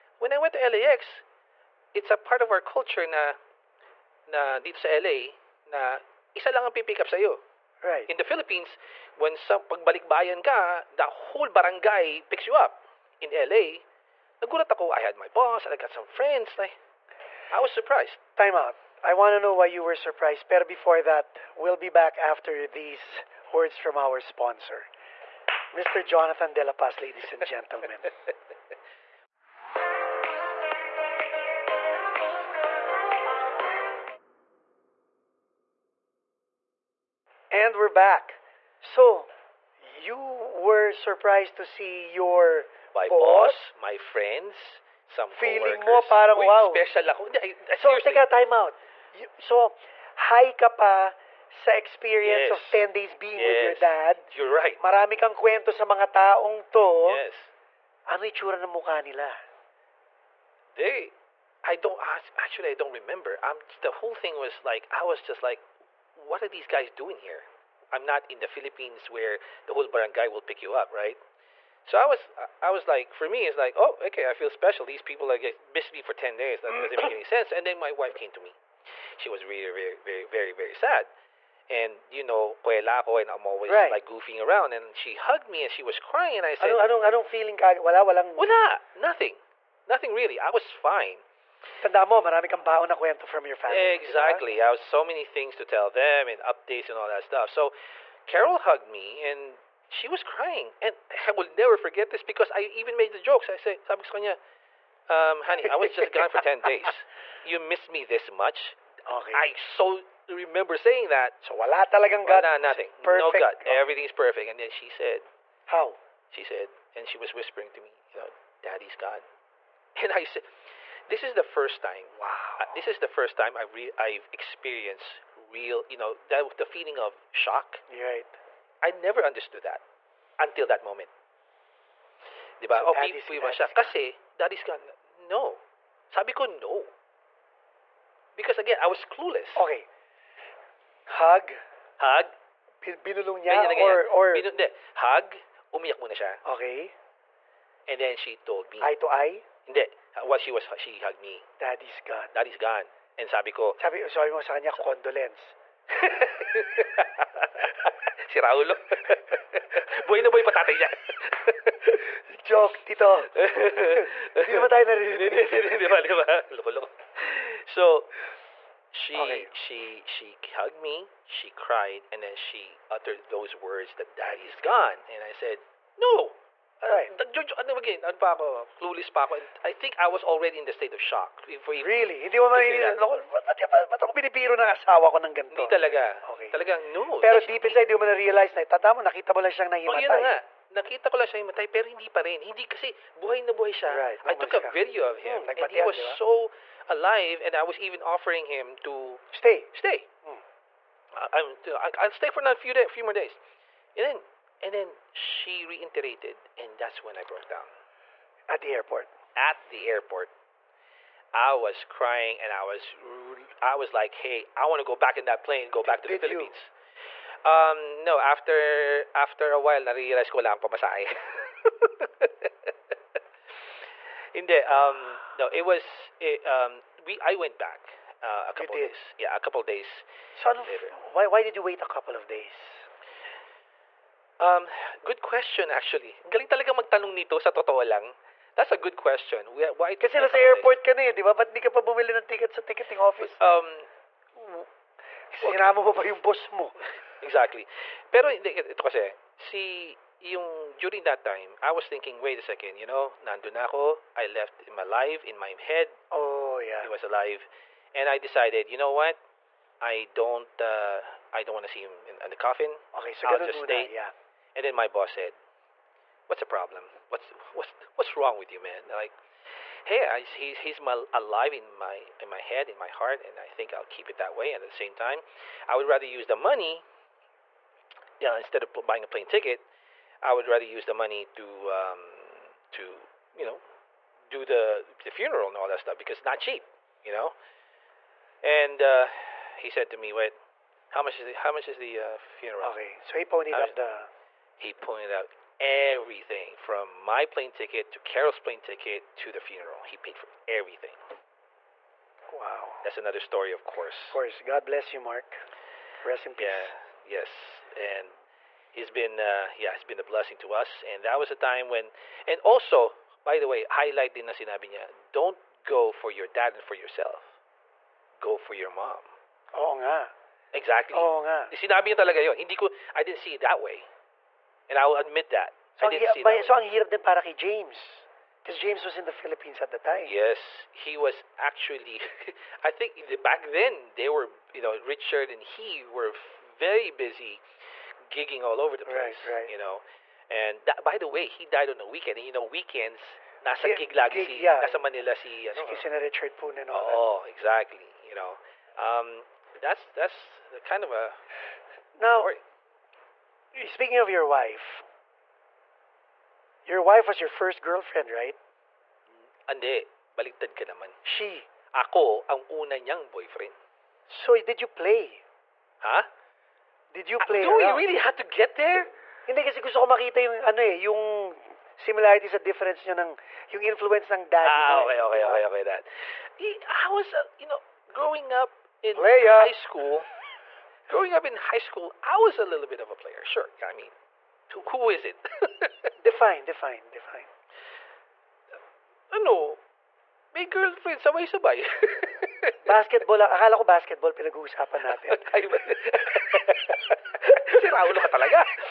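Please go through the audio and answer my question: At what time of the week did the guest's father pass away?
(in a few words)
A weekend.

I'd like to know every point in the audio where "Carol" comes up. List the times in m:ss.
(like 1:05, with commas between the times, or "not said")
1:38, 4:57.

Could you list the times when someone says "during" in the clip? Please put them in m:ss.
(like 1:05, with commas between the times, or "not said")
4:10.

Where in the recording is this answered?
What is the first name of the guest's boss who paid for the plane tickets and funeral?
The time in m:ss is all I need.
5:04.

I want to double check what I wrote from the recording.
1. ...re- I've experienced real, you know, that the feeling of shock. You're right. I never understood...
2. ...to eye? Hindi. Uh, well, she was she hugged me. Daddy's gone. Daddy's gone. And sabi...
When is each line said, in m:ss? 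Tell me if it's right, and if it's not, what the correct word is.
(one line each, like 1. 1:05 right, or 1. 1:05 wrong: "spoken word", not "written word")
1. 2:03 right
2. 2:28 right.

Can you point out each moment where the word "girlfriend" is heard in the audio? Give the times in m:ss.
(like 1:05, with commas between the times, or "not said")
5:57, 6:30.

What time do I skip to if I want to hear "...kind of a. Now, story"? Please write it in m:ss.
5:50.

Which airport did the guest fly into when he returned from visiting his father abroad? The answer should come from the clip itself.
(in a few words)
LAX.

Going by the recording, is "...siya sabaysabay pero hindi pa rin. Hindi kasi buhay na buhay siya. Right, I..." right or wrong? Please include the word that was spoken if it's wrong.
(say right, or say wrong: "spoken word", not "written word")
wrong: "matay", not "sabaysabay".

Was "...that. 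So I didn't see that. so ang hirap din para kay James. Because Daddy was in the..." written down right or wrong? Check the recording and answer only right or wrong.
wrong.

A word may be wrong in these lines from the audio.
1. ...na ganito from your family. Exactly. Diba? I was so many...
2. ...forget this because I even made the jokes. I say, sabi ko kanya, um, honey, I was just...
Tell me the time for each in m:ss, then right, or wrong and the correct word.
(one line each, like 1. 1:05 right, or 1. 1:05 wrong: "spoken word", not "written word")
1. 1:32 wrong: "kwento", not "ganito"
2. 1:41 right.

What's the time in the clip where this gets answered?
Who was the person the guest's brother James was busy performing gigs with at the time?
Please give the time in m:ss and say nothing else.
5:46.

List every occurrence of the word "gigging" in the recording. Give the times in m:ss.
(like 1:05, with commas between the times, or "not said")
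5:38.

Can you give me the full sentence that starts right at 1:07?
I'm not in the Philippines where the whole barangay will pick you up, right?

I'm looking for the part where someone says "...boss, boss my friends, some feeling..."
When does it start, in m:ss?
0:43.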